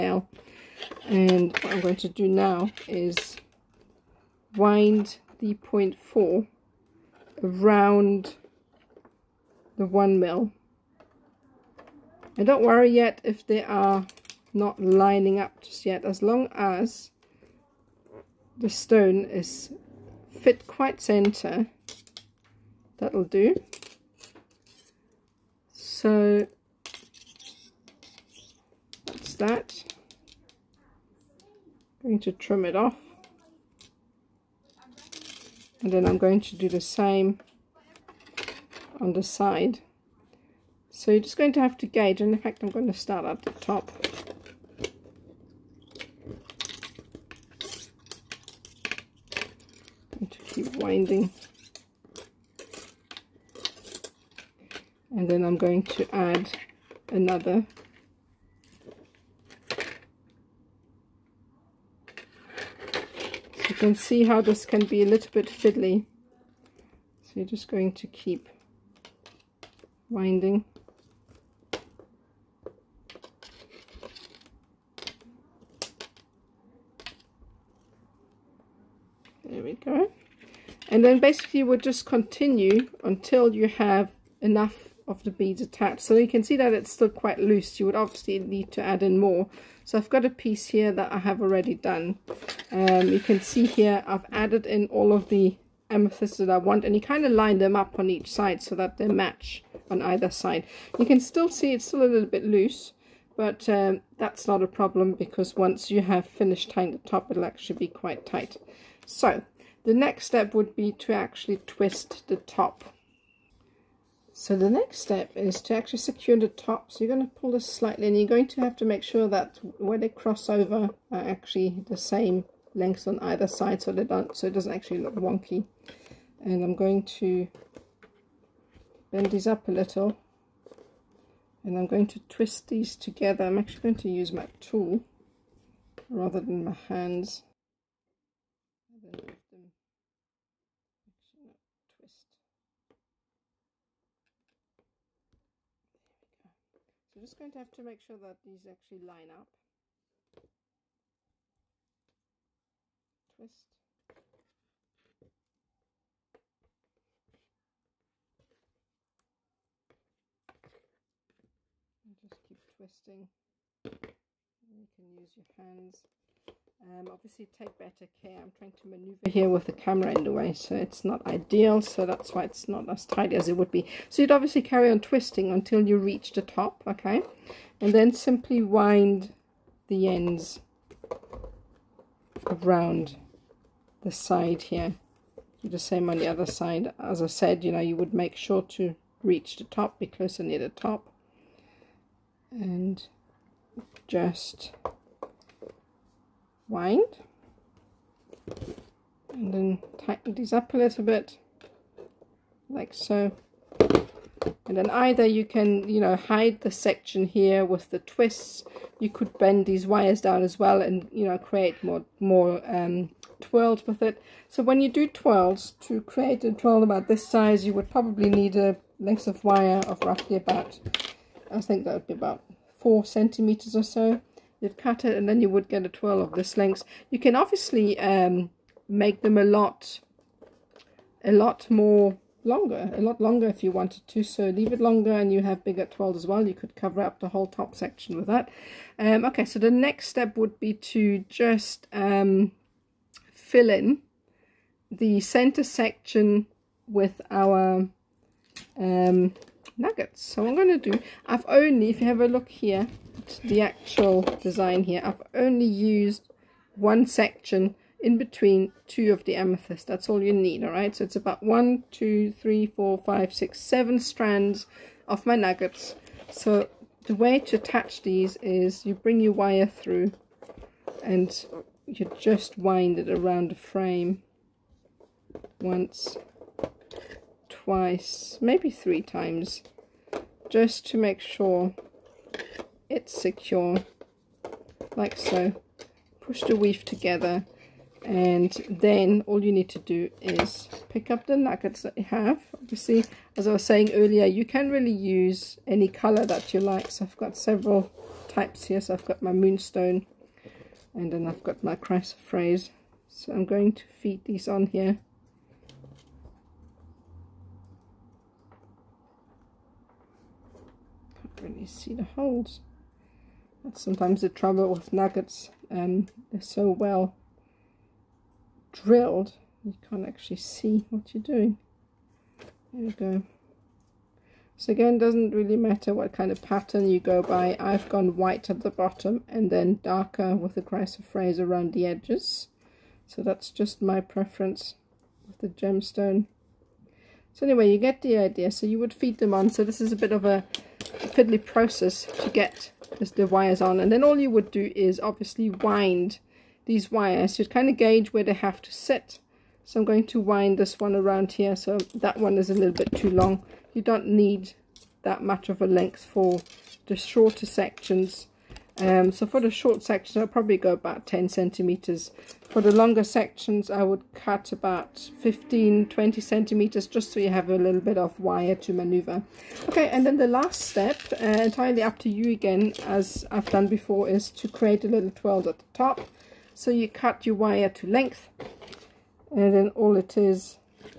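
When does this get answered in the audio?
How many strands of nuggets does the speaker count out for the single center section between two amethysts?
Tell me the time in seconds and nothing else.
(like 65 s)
263 s.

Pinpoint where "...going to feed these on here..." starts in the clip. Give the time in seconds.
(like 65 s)
303 s.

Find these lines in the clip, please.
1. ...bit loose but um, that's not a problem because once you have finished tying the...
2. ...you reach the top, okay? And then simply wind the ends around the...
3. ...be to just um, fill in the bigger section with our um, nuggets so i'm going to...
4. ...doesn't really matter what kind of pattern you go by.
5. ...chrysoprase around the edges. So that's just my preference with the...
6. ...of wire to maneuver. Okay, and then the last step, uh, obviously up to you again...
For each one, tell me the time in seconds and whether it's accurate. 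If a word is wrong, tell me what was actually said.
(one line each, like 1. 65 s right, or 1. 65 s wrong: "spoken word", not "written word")
1. 102 s right
2. 175 s right
3. 240 s wrong: "center", not "bigger"
4. 324 s right
5. 330 s right
6. 367 s wrong: "entirely", not "obviously".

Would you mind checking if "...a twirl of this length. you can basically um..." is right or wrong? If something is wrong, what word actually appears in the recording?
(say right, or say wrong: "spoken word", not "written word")
wrong: "obviously", not "basically".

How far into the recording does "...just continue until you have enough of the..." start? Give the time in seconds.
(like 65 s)
81 s.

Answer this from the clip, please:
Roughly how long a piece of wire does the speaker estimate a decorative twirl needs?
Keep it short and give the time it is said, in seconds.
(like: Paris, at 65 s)
4 centimeters, at 222 s.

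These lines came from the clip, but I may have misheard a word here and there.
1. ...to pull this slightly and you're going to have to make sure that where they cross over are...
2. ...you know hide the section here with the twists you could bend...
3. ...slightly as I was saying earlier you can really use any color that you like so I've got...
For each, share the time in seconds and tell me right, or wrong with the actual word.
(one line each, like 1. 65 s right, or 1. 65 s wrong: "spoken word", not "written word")
1. 117 s right
2. 205 s right
3. 292 s wrong: "obviously", not "slightly".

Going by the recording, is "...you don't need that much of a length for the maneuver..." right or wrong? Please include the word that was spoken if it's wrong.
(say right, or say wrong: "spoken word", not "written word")
wrong: "shorter", not "maneuver".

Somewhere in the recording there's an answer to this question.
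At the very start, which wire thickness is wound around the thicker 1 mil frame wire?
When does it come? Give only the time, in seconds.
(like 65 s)
5 s.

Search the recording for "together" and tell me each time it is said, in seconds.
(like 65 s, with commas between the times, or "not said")
132 s, 286 s.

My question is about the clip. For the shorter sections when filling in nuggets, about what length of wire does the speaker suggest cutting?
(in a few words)
10 centimeters.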